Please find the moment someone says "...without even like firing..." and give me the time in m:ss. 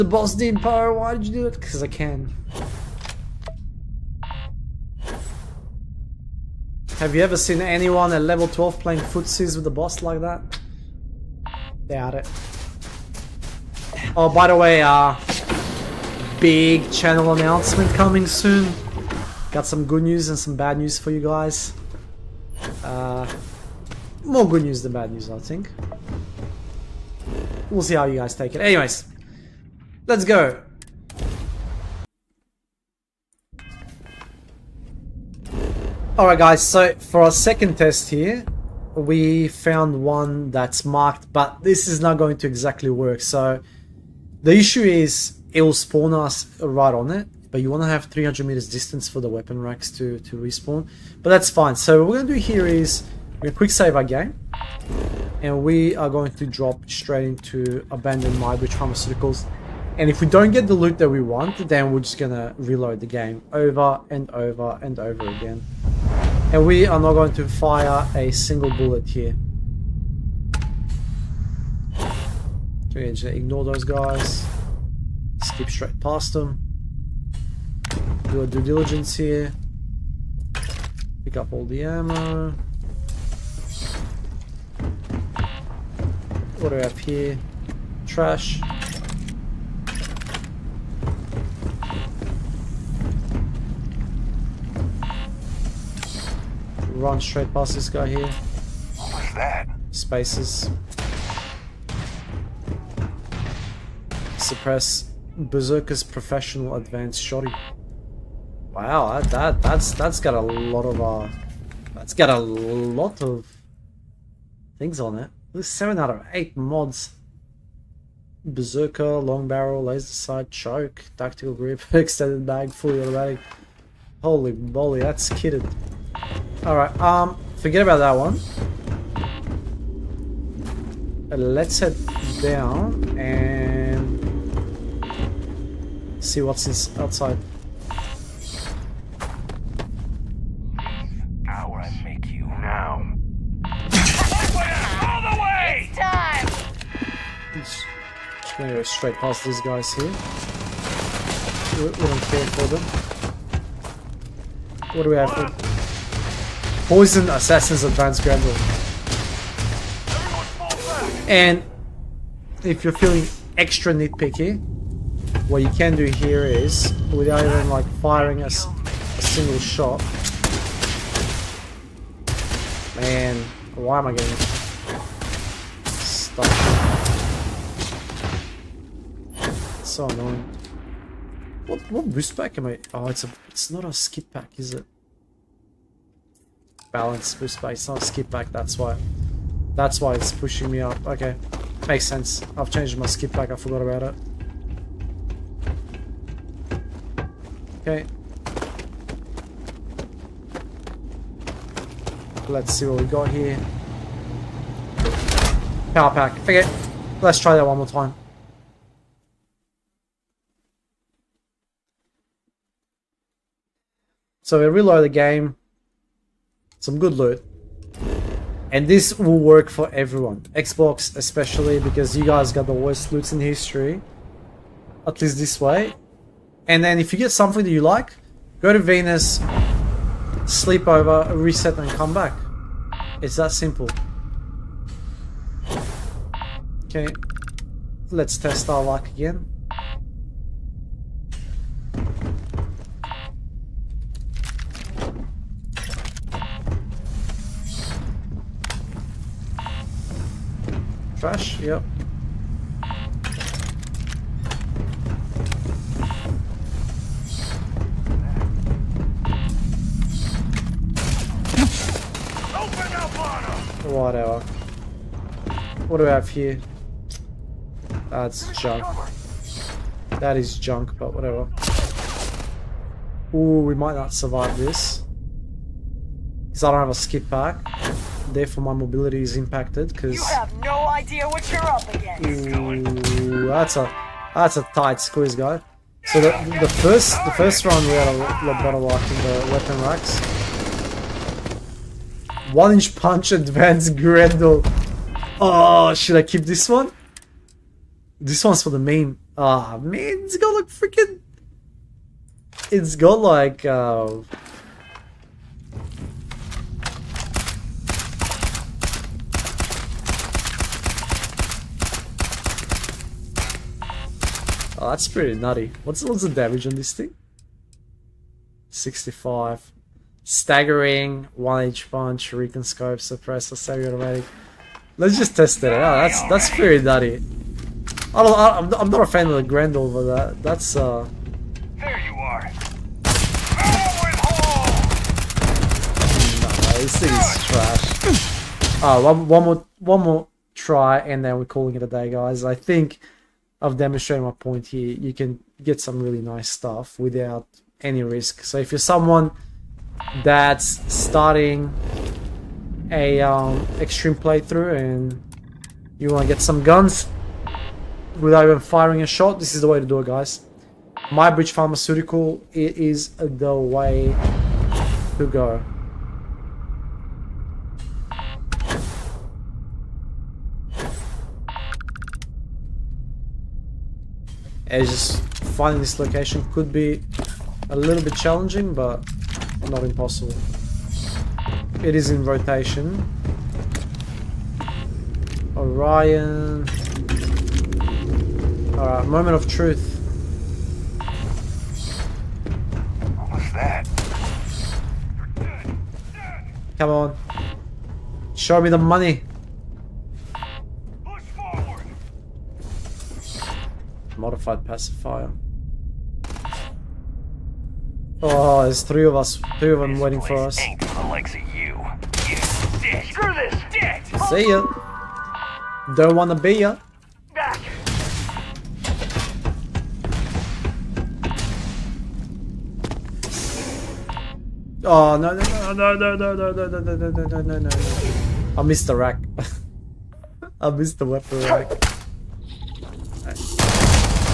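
2:47.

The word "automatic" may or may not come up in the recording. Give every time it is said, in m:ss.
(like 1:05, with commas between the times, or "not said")
2:03, 5:23.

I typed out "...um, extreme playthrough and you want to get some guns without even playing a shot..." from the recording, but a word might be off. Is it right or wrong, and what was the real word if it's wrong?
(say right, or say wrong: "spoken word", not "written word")
wrong: "firing", not "playing".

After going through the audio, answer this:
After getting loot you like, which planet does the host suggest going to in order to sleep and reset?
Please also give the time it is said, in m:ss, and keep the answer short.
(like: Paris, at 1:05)
Venus, at 3:48.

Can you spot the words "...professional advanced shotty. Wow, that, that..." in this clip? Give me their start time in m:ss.
1:46.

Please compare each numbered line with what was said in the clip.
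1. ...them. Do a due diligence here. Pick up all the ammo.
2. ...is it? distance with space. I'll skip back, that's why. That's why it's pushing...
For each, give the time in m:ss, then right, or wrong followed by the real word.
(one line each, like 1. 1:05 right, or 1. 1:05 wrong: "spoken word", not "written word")
1. 1:16 right
2. 3:04 wrong: "balance", not "distance".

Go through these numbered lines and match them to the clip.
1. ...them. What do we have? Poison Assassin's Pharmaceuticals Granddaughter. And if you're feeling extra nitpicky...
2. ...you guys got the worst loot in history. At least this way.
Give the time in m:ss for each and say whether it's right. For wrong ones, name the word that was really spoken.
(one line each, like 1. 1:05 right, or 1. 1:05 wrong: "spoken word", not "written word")
1. 2:32 wrong: "Advanced", not "Pharmaceuticals"
2. 3:42 right.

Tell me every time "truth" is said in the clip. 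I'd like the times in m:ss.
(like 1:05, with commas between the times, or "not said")
6:29.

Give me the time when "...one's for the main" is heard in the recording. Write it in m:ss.
4:58.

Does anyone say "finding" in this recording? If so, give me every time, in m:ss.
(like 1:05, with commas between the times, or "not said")
6:15.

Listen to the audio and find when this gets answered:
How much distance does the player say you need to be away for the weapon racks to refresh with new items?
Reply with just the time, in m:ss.
0:48.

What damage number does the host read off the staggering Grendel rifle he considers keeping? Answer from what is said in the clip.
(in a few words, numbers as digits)
65.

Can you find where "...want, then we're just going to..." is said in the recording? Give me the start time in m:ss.
1:01.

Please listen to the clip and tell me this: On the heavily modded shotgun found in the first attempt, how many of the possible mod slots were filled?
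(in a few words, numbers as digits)
7 out of 8.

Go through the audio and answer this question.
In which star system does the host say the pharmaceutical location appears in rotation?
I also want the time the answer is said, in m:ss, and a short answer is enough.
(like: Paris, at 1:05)
Orion, at 6:25.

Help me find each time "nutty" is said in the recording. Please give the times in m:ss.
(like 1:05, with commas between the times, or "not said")
5:15, 5:26.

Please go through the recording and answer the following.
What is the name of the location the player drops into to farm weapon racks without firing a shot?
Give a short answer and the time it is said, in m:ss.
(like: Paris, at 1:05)
Abandoned Mybridge Pharmaceuticals, at 0:57.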